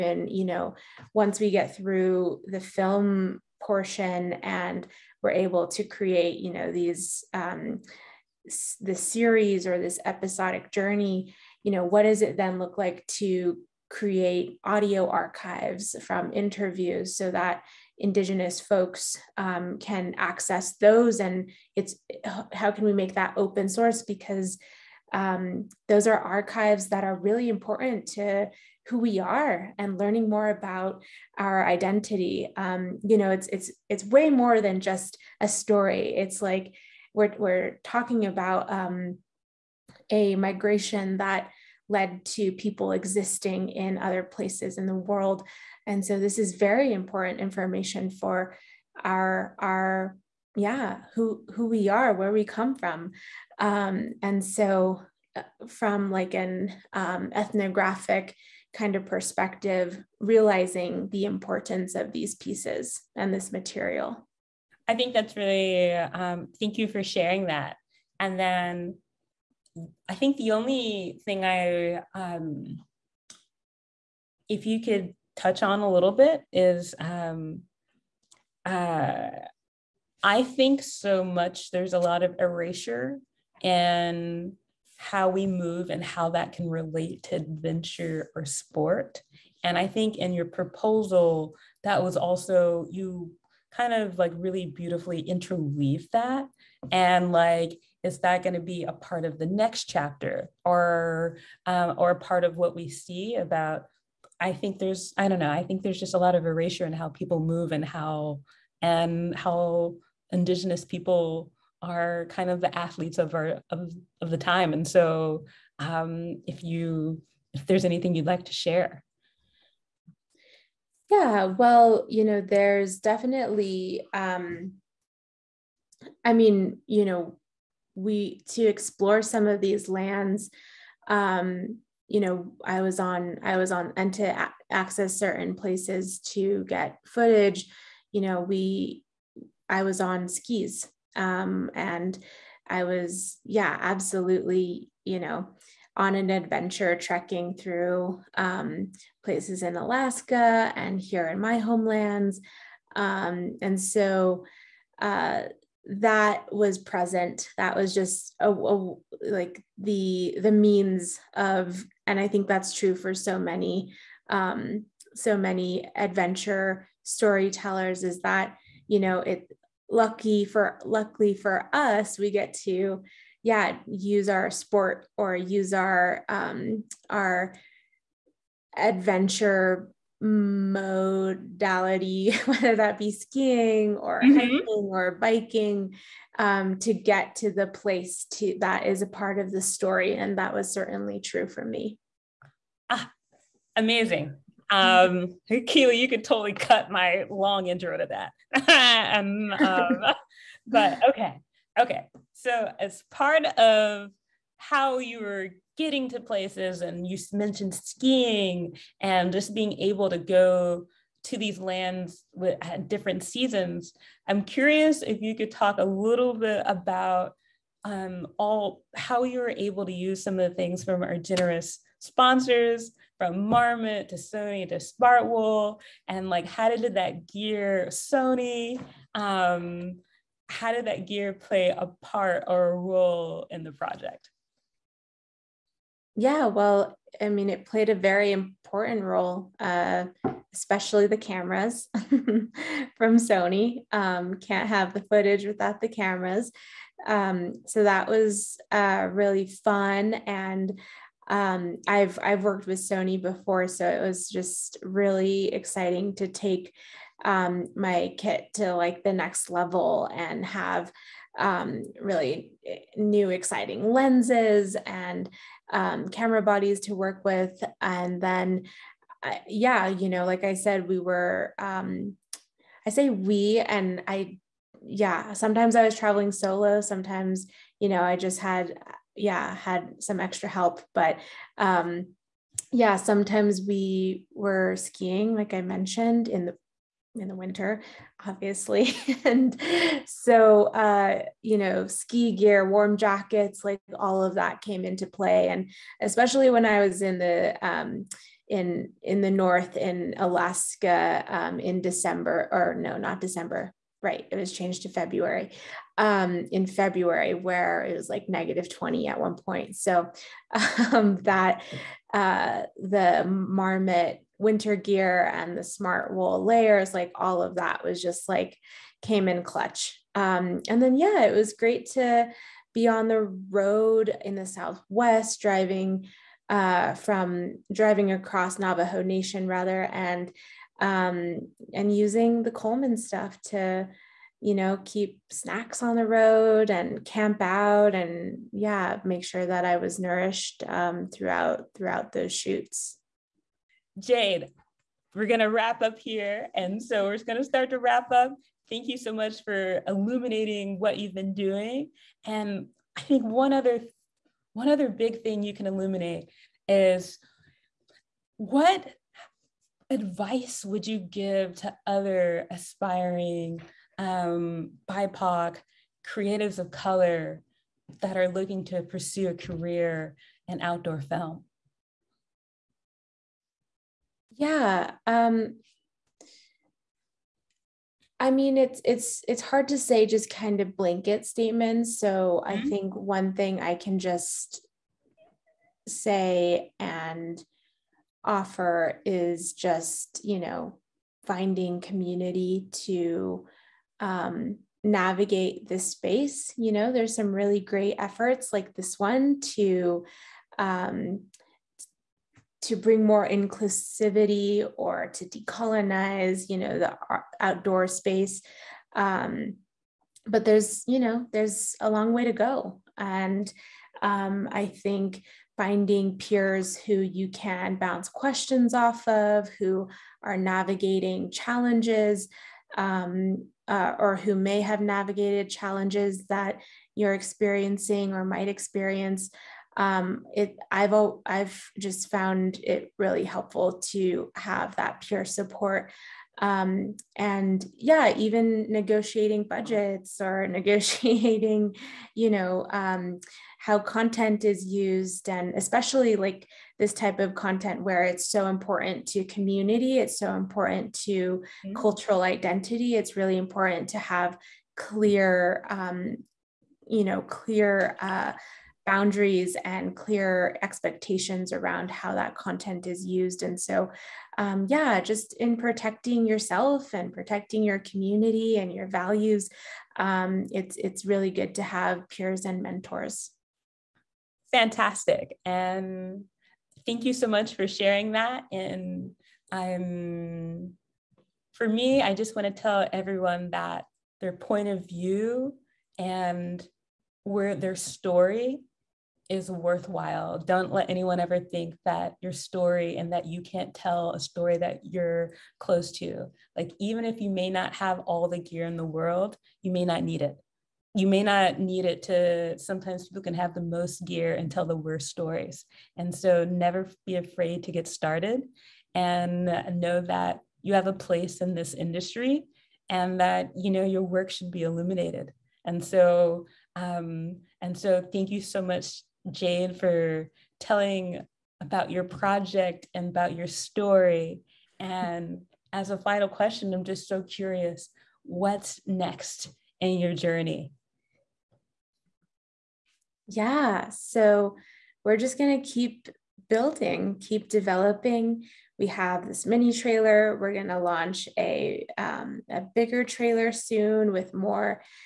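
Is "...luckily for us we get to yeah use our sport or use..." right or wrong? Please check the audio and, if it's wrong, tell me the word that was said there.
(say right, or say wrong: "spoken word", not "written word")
right.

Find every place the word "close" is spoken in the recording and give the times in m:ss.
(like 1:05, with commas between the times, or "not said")
8:15.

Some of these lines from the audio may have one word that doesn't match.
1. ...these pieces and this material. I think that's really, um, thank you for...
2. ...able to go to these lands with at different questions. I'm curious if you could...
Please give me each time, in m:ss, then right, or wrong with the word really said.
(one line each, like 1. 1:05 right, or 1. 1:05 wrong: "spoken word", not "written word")
1. 1:02 right
2. 3:29 wrong: "seasons", not "questions".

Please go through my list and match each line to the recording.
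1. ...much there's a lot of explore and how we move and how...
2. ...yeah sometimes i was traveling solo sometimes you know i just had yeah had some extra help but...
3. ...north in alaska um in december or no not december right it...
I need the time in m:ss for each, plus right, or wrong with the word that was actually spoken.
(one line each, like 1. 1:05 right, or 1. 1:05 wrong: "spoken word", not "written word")
1. 1:21 wrong: "erasure", not "explore"
2. 4:34 right
3. 4:59 right.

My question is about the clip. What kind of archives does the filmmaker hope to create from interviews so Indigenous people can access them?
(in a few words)
audio archives.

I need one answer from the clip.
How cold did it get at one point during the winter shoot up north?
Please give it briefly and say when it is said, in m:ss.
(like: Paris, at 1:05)
-20, at 5:08.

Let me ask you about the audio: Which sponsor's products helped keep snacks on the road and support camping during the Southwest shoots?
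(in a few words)
Coleman.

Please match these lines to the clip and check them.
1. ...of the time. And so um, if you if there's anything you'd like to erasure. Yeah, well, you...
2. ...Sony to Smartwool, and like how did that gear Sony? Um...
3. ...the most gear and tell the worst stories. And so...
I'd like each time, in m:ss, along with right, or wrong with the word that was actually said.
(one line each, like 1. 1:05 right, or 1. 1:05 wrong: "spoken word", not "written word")
1. 1:54 wrong: "share", not "erasure"
2. 3:44 right
3. 8:23 right.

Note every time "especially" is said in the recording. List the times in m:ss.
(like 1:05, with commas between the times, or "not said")
4:00, 4:55, 7:25.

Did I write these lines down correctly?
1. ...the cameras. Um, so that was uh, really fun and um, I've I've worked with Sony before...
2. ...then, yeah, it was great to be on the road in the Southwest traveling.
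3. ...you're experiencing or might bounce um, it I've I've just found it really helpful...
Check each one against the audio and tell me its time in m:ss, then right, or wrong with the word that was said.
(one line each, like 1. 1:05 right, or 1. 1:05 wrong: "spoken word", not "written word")
1. 4:05 right
2. 5:20 wrong: "driving", not "traveling"
3. 7:06 wrong: "experience", not "bounce".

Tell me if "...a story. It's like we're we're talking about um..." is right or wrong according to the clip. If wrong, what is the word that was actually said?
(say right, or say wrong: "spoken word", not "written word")
right.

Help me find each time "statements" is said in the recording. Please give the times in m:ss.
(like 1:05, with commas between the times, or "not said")
6:21.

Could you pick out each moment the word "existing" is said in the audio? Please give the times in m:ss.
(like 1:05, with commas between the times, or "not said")
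0:42.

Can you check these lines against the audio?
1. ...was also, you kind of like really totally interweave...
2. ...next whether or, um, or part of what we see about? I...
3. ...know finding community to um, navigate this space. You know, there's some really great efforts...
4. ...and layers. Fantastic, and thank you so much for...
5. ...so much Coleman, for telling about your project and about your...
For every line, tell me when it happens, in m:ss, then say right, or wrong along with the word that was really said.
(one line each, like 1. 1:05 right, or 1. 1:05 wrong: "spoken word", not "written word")
1. 1:32 wrong: "beautifully", not "totally"
2. 1:39 wrong: "chapter", not "whether"
3. 6:30 right
4. 7:52 wrong: "mentors", not "layers"
5. 8:38 wrong: "Jade", not "Coleman".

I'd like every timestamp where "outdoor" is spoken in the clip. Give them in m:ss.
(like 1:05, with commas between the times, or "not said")
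6:10, 6:47.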